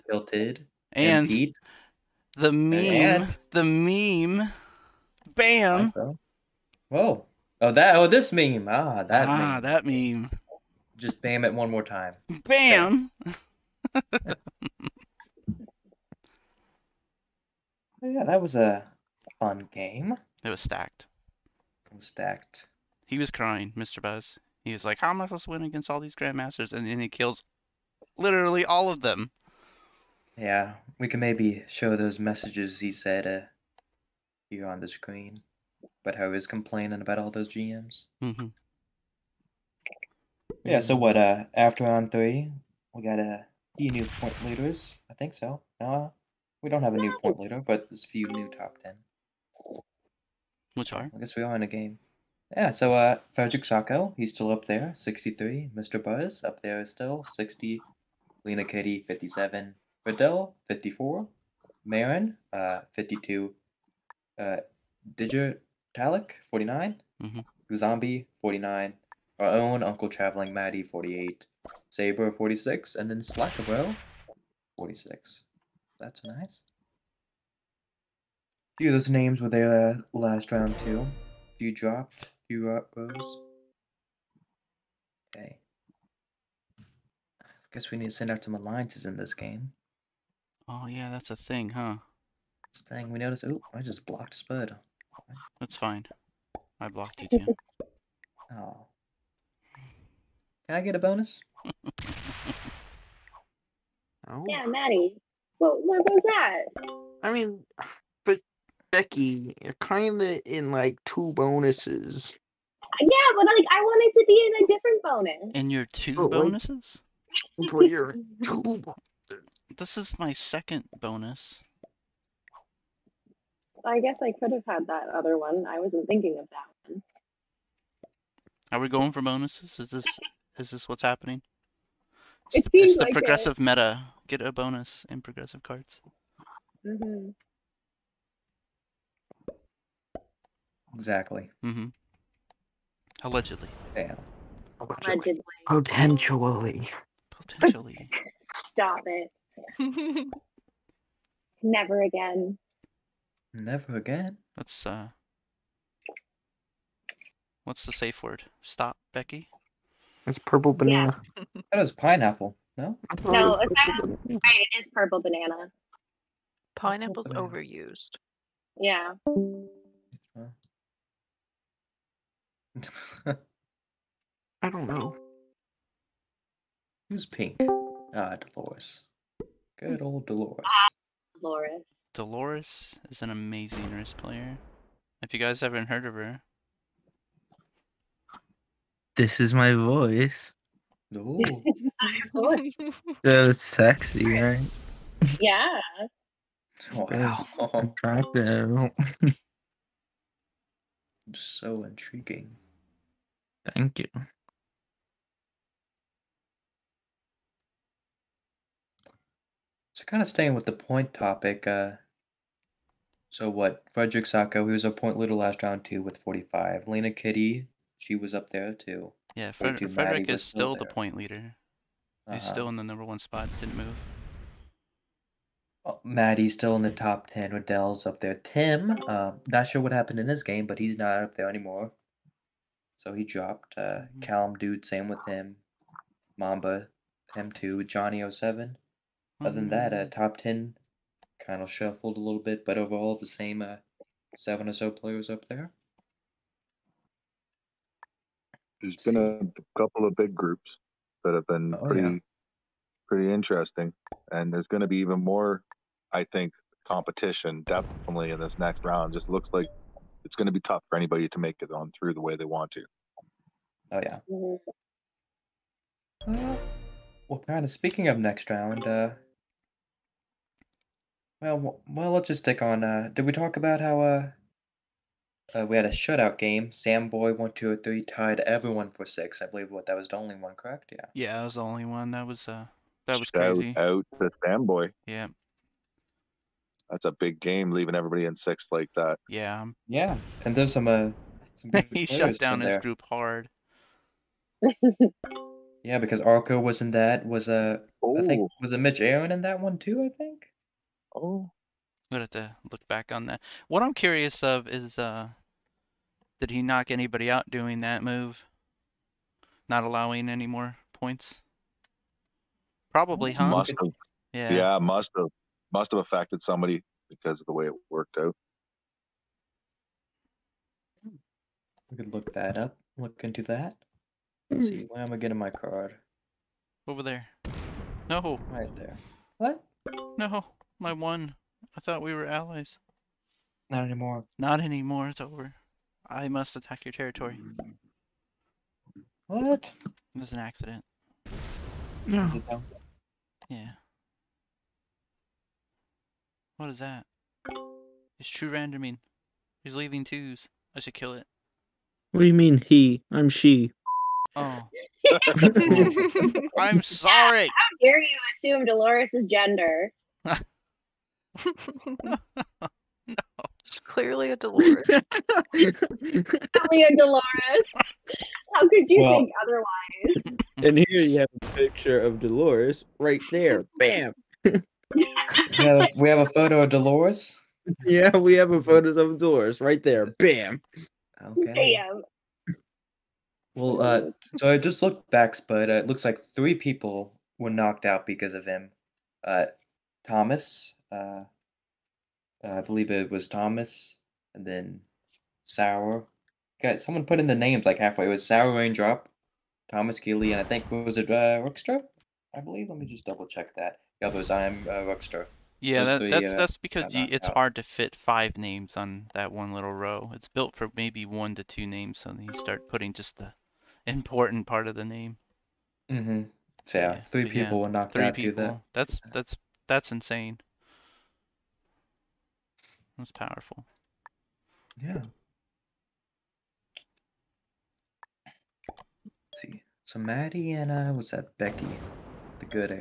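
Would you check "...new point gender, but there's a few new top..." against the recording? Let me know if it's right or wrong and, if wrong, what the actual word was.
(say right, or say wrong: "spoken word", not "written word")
wrong: "leader", not "gender".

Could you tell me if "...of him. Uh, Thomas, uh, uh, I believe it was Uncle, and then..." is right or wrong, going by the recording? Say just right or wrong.
wrong.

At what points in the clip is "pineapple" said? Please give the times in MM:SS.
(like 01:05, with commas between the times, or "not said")
02:41, 02:46.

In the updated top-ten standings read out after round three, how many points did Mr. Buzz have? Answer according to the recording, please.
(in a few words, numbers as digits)
60.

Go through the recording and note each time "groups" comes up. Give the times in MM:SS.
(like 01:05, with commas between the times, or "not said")
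04:10, 04:52.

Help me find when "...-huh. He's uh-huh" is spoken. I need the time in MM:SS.
03:41.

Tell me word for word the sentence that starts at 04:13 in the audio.
pretty interesting, and there's going to be even more.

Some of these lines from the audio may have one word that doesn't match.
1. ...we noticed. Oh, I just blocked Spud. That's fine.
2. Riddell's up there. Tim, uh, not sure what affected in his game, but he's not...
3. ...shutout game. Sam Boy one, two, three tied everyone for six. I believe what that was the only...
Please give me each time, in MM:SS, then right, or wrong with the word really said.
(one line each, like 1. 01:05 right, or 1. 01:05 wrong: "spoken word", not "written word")
1. 01:33 right
2. 03:47 wrong: "happened", not "affected"
3. 04:35 right.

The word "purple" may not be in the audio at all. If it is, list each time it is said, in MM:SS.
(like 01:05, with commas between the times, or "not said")
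02:40, 02:44.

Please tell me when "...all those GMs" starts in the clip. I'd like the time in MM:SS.
00:37.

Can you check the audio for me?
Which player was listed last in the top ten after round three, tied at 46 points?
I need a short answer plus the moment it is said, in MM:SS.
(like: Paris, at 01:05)
Slackabro, at 01:13.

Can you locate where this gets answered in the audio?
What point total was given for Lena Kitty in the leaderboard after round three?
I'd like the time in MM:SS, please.
00:59.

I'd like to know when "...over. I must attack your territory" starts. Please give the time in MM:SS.
05:35.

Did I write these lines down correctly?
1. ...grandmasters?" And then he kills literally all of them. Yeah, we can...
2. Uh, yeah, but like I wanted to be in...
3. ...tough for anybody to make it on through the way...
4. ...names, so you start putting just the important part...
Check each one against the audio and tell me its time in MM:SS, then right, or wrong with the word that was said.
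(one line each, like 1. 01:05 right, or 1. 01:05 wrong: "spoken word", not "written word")
1. 00:26 right
2. 01:52 right
3. 04:20 right
4. 06:51 right.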